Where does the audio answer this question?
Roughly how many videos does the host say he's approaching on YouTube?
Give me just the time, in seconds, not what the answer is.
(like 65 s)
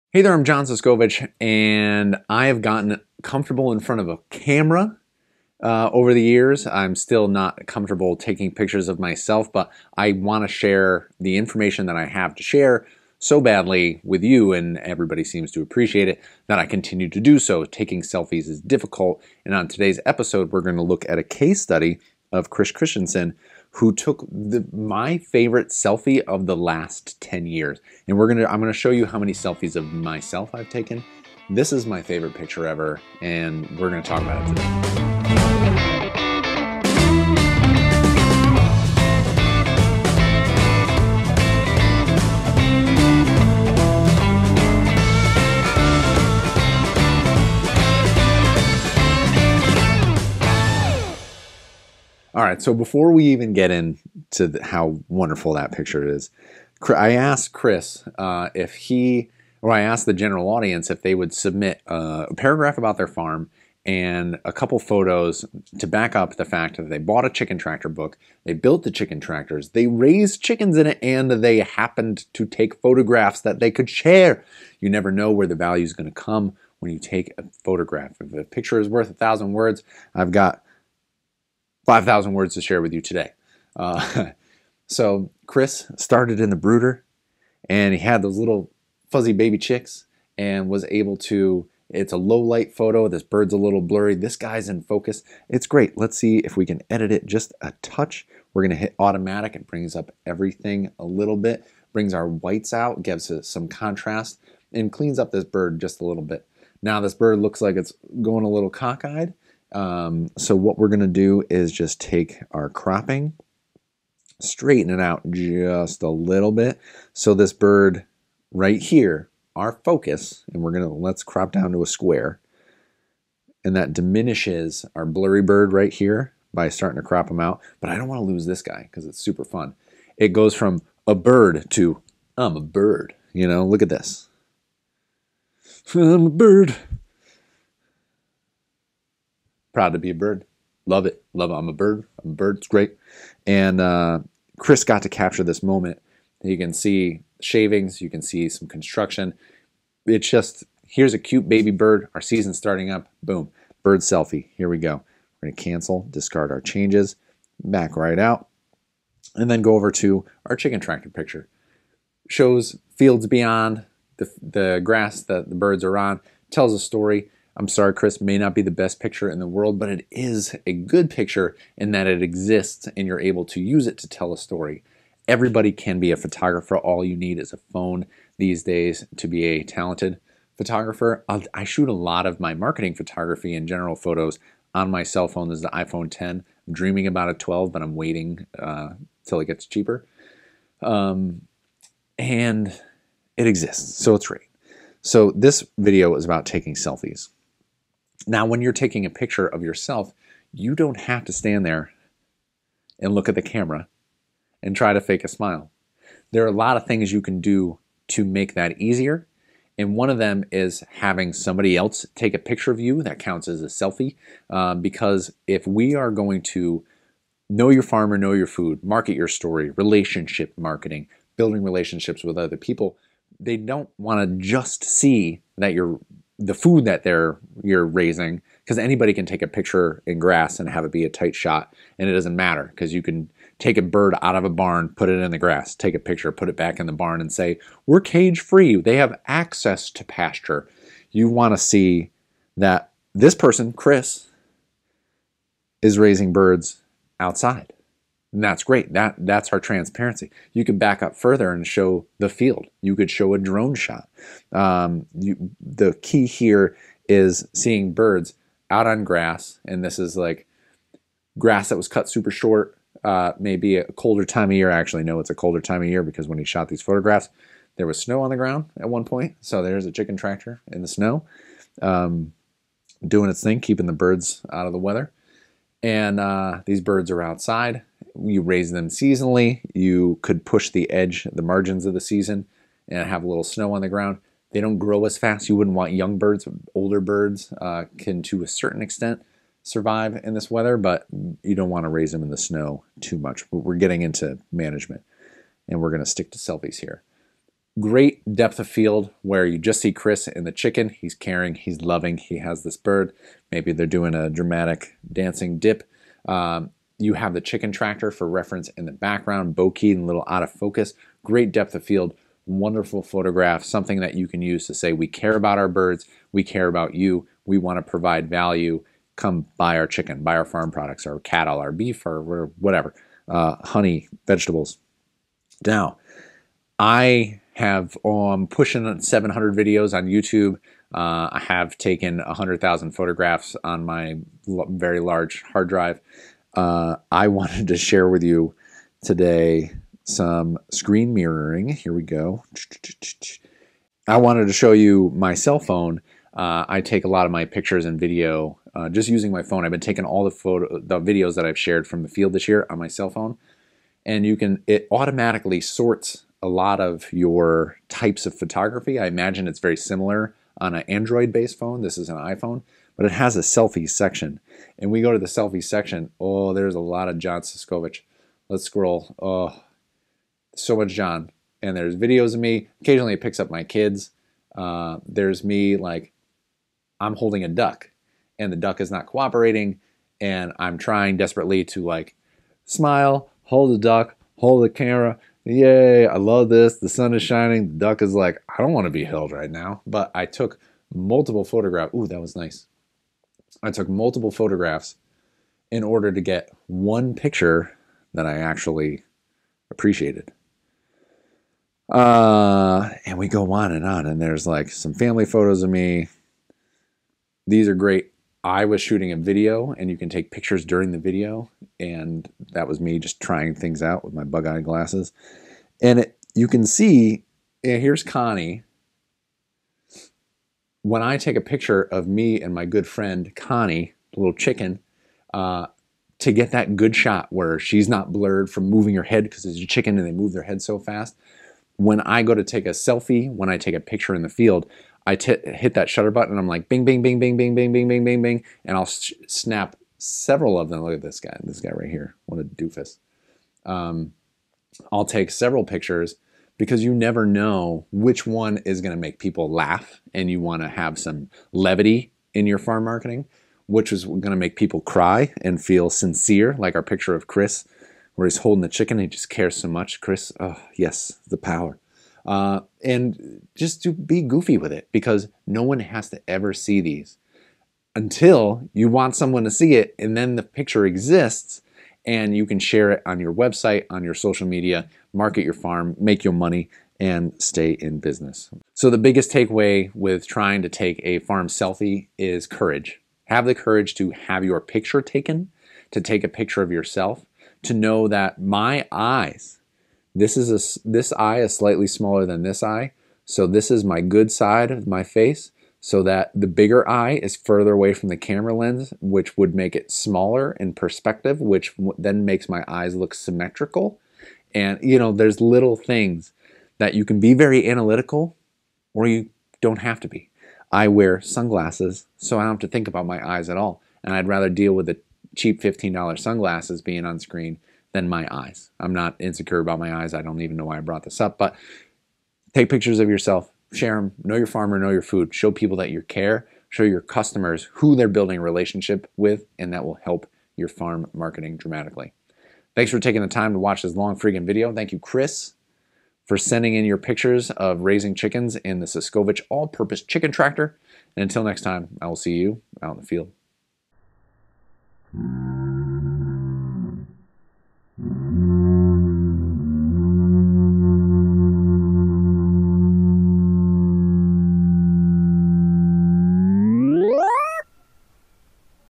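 328 s.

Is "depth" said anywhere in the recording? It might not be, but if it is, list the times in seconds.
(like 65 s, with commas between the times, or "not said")
298 s, 311 s.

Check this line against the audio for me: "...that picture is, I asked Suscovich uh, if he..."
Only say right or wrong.
wrong.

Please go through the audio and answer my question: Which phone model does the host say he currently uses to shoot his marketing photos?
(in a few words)
iPhone 10.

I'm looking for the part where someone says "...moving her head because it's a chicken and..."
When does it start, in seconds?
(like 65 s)
428 s.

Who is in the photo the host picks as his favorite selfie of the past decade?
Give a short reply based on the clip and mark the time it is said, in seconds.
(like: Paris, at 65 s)
Chris Christensen, at 22 s.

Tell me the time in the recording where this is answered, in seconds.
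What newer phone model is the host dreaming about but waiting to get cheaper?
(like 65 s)
187 s.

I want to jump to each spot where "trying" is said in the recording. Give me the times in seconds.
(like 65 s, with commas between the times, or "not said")
380 s, 413 s, 480 s.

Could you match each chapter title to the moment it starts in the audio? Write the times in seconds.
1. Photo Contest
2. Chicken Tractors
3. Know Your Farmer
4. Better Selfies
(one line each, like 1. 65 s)
1. 53 s
2. 160 s
3. 198 s
4. 343 s.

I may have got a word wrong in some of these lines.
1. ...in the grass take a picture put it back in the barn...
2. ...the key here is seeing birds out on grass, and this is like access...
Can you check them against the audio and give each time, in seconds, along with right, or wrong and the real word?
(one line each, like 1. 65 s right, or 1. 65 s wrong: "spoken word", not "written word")
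1. 235 s right
2. 255 s wrong: "grass", not "access".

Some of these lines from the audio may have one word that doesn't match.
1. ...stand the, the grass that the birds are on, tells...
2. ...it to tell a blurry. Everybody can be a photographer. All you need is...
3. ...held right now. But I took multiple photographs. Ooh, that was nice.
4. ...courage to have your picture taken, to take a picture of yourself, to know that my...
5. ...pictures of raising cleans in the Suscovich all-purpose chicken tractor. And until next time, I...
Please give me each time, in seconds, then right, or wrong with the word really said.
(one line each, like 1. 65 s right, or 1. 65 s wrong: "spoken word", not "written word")
1. 163 s wrong: "beyond", not "stand"
2. 173 s wrong: "story", not "blurry"
3. 389 s right
4. 483 s right
5. 536 s wrong: "chickens", not "cleans".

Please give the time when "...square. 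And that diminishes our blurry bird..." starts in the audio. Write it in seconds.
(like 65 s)
121 s.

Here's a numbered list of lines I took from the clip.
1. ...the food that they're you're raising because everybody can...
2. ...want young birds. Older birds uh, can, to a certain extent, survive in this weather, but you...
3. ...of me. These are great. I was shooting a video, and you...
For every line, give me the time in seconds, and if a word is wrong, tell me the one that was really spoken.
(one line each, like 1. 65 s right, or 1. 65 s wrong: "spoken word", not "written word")
1. 226 s wrong: "anybody", not "everybody"
2. 285 s right
3. 405 s right.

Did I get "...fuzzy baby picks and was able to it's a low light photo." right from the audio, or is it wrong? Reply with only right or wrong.
wrong.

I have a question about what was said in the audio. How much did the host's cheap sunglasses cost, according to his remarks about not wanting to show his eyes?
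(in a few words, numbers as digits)
$15.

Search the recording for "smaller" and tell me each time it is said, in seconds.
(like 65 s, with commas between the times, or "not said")
491 s, 499 s.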